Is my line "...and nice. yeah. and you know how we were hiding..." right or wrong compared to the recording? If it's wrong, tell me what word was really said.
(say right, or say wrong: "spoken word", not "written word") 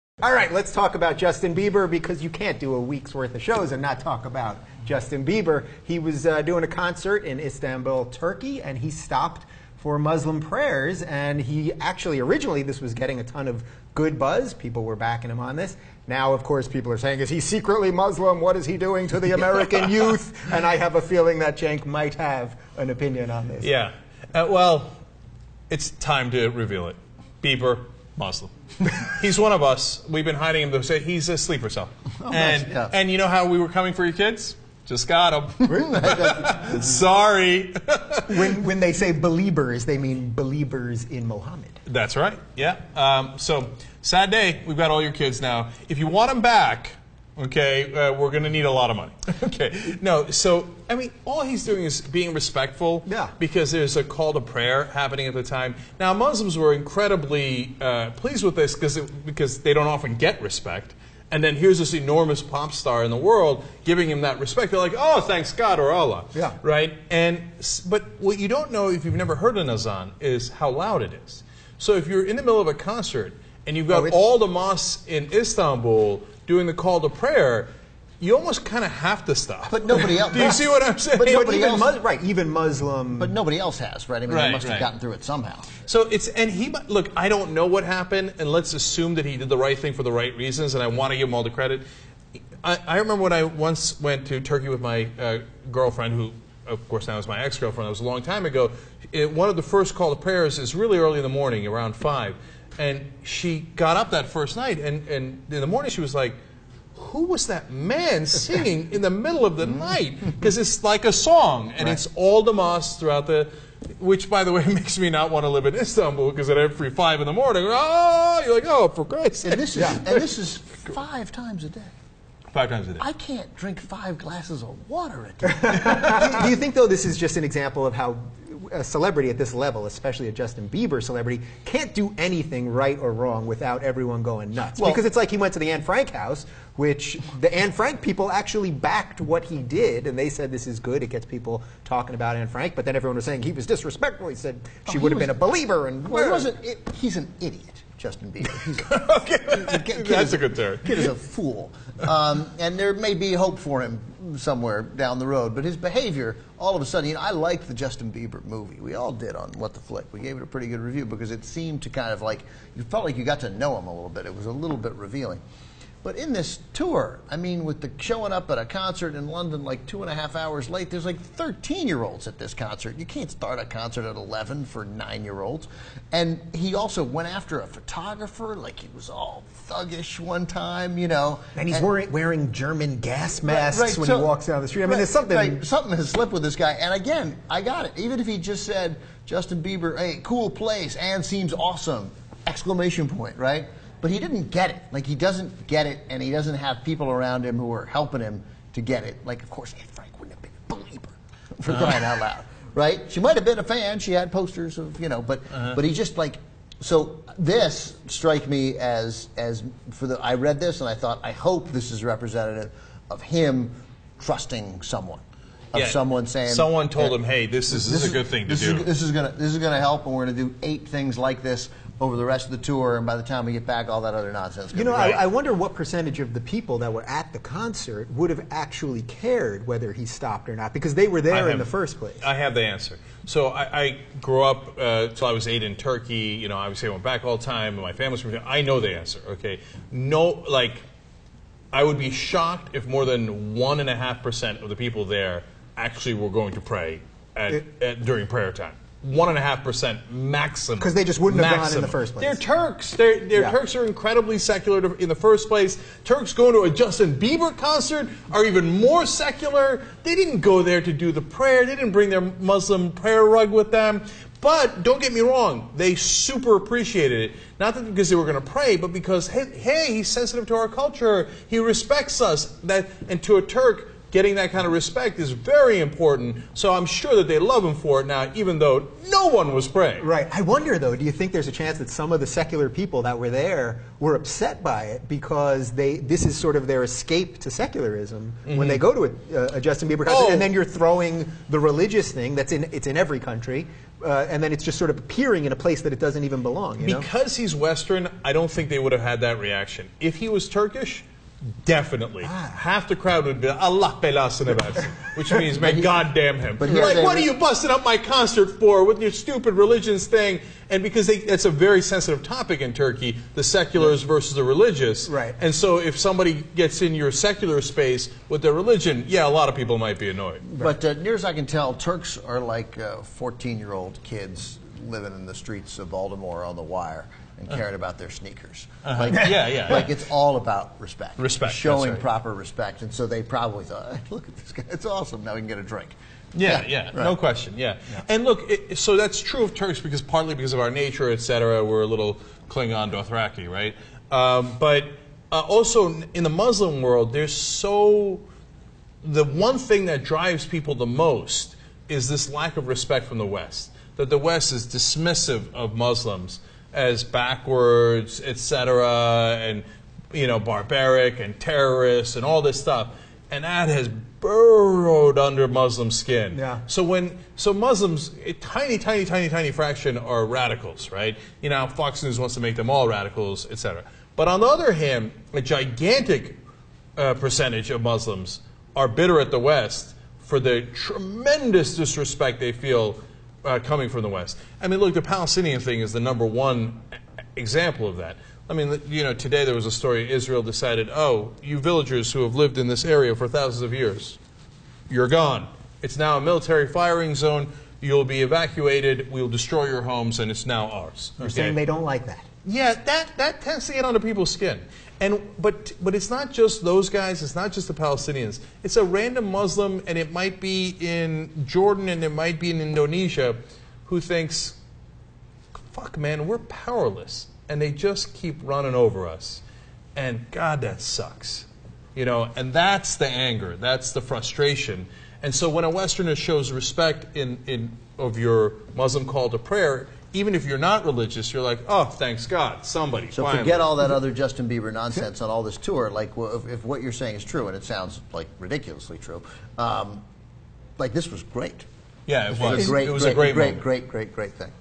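wrong: "coming", not "hiding".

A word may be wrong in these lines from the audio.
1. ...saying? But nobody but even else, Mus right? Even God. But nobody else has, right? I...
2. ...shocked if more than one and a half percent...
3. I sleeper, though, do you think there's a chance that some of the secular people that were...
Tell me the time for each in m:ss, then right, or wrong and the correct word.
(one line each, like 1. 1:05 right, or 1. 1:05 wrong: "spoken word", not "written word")
1. 1:20 wrong: "Muslim", not "God"
2. 4:02 right
3. 4:40 wrong: "wonder", not "sleeper".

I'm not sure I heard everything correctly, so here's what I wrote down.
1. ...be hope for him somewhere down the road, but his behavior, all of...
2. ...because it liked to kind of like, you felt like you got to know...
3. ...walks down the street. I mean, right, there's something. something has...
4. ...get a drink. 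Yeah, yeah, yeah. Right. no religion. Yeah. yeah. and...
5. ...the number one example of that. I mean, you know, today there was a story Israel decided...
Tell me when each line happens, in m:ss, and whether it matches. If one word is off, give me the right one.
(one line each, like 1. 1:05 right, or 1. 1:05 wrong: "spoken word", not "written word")
1. 2:33 right
2. 2:41 wrong: "seemed", not "liked"
3. 3:04 right
4. 5:35 wrong: "question", not "religion"
5. 6:25 right.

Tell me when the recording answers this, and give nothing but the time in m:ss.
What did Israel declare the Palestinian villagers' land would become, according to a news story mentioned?
6:36.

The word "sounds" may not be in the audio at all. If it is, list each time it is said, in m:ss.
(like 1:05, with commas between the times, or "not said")
7:17.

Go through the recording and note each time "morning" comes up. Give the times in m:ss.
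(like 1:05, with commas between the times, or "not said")
1:41, 1:45, 1:57.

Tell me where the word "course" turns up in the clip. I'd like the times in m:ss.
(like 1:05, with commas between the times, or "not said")
0:16, 1:36, 3:19.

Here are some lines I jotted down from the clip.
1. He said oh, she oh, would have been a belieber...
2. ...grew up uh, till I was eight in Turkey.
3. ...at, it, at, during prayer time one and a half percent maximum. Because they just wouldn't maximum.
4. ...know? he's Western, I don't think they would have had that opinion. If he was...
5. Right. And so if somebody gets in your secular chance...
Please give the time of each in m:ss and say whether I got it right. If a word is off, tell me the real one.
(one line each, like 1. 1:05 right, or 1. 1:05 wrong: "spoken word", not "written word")
1. 2:24 right
2. 3:54 right
3. 4:07 right
4. 4:57 wrong: "reaction", not "opinion"
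5. 5:15 wrong: "space", not "chance".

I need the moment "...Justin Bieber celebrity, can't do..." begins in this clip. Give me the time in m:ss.
2:10.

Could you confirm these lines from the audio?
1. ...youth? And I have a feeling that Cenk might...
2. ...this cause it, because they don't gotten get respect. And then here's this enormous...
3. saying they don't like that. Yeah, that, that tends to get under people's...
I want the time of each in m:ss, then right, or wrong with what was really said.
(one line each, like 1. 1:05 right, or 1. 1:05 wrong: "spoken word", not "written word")
1. 0:19 right
2. 0:58 wrong: "often", not "gotten"
3. 6:41 right.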